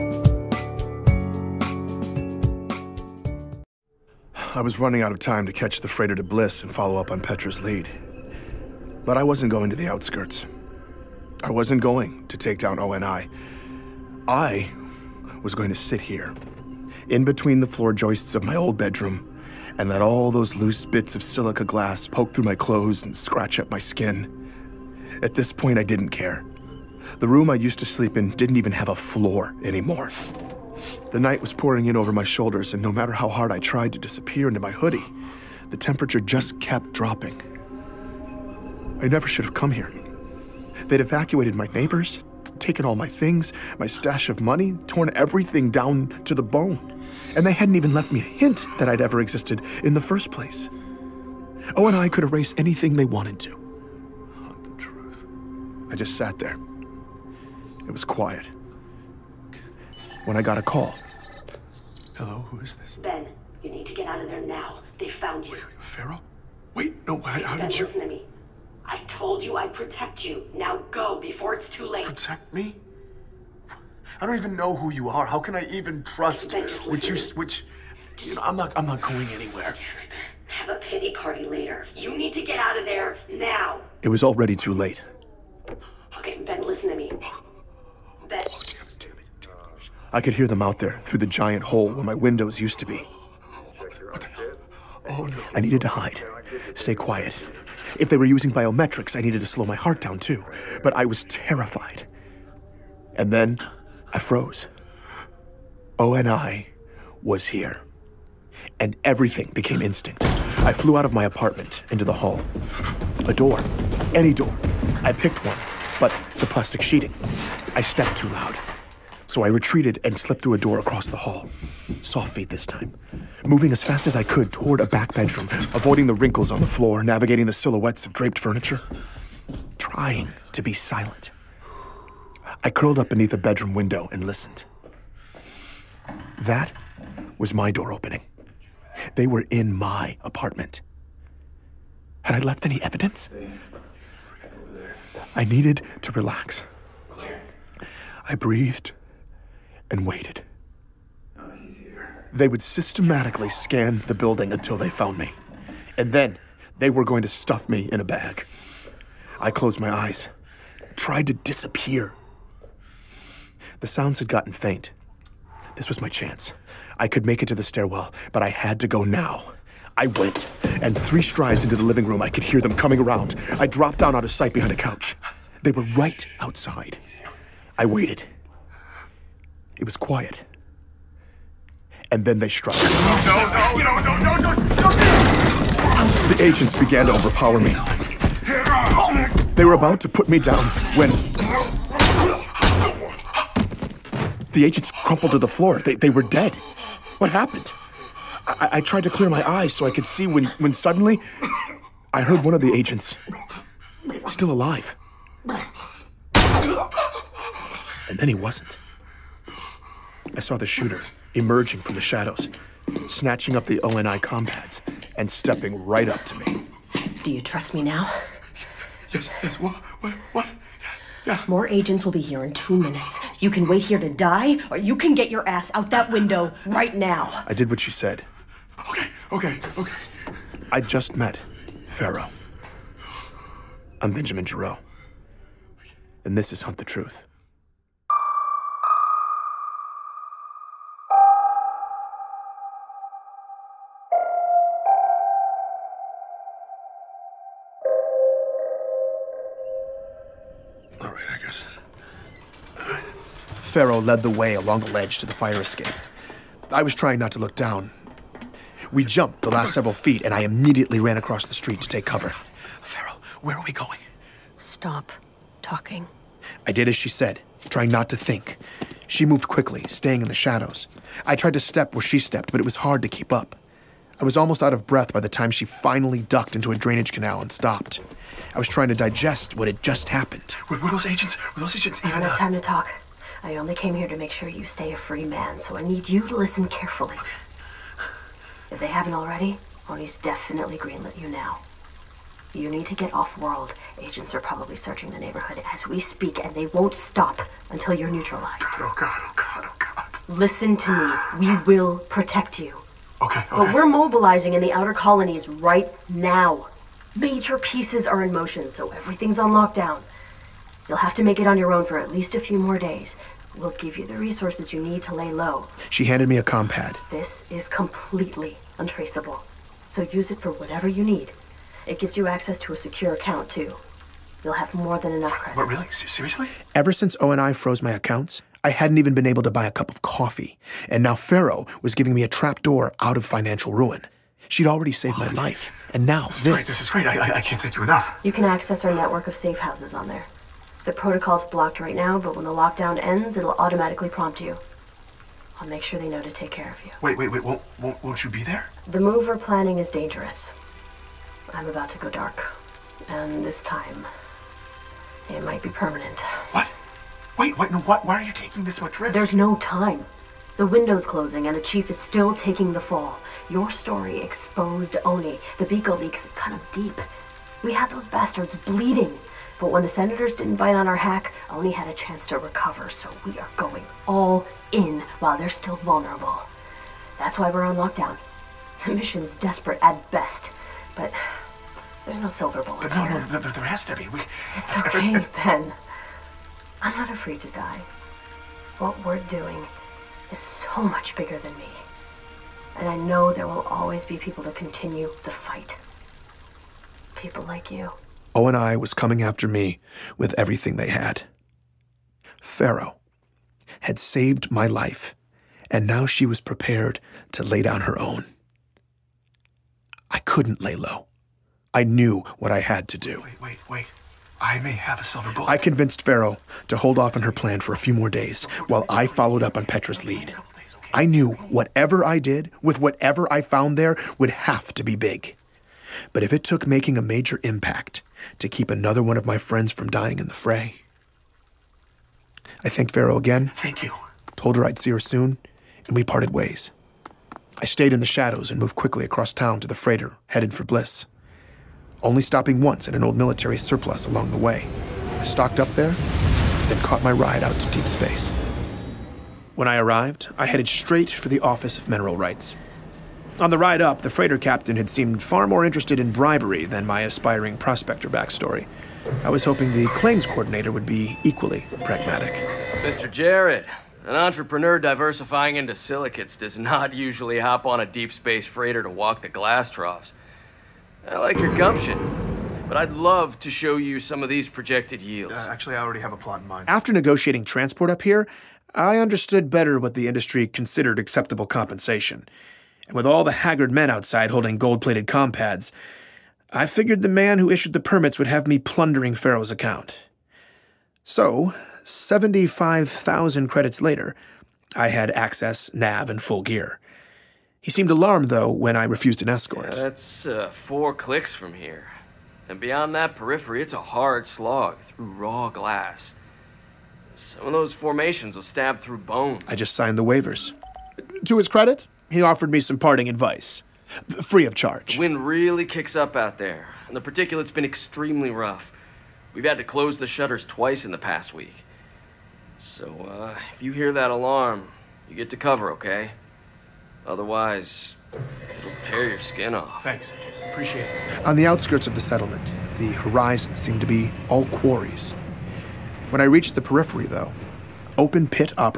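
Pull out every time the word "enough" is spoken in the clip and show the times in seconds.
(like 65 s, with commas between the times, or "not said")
325 s, 337 s.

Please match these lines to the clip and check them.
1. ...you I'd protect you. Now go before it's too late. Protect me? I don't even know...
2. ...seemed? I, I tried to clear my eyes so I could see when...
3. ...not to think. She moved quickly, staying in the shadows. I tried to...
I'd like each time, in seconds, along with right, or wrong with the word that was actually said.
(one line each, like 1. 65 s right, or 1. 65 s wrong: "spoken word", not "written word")
1. 69 s right
2. 197 s wrong: "happened", not "seemed"
3. 267 s right.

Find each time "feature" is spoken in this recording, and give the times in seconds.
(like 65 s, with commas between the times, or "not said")
not said.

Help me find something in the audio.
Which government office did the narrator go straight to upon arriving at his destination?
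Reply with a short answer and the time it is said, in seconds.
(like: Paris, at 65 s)
Office of Mineral Rights, at 451 s.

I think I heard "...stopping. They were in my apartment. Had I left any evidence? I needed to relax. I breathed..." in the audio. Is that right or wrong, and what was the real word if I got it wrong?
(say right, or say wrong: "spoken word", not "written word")
wrong: "opening", not "stopping".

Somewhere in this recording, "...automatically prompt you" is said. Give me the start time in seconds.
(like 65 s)
343 s.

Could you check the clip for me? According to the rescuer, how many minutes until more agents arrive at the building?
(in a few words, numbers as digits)
2.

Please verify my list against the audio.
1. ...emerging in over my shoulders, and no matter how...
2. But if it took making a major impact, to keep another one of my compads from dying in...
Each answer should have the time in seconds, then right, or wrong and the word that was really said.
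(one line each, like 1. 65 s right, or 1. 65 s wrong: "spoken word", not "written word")
1. 31 s wrong: "pouring", not "emerging"
2. 426 s wrong: "friends", not "compads".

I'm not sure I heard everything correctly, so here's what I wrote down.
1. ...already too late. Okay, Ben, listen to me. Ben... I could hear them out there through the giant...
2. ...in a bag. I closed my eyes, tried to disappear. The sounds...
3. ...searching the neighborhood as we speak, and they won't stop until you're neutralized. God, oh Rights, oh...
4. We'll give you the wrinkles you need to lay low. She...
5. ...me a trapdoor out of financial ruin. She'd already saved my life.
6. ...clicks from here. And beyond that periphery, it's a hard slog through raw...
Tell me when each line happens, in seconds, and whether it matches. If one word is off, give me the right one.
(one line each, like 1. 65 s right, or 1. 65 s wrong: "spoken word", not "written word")
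1. 84 s right
2. 157 s right
3. 294 s wrong: "God", not "Rights"
4. 313 s wrong: "resources", not "wrinkles"
5. 332 s right
6. 500 s right.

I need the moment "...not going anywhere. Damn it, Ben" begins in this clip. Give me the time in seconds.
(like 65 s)
78 s.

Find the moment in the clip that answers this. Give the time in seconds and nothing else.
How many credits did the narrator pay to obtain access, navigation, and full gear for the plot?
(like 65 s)
491 s.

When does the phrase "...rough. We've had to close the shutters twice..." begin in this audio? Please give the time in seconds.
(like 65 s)
518 s.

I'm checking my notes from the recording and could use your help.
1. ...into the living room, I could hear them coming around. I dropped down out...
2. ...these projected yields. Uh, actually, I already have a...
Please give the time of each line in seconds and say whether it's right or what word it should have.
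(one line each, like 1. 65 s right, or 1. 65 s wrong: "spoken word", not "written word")
1. 171 s right
2. 474 s right.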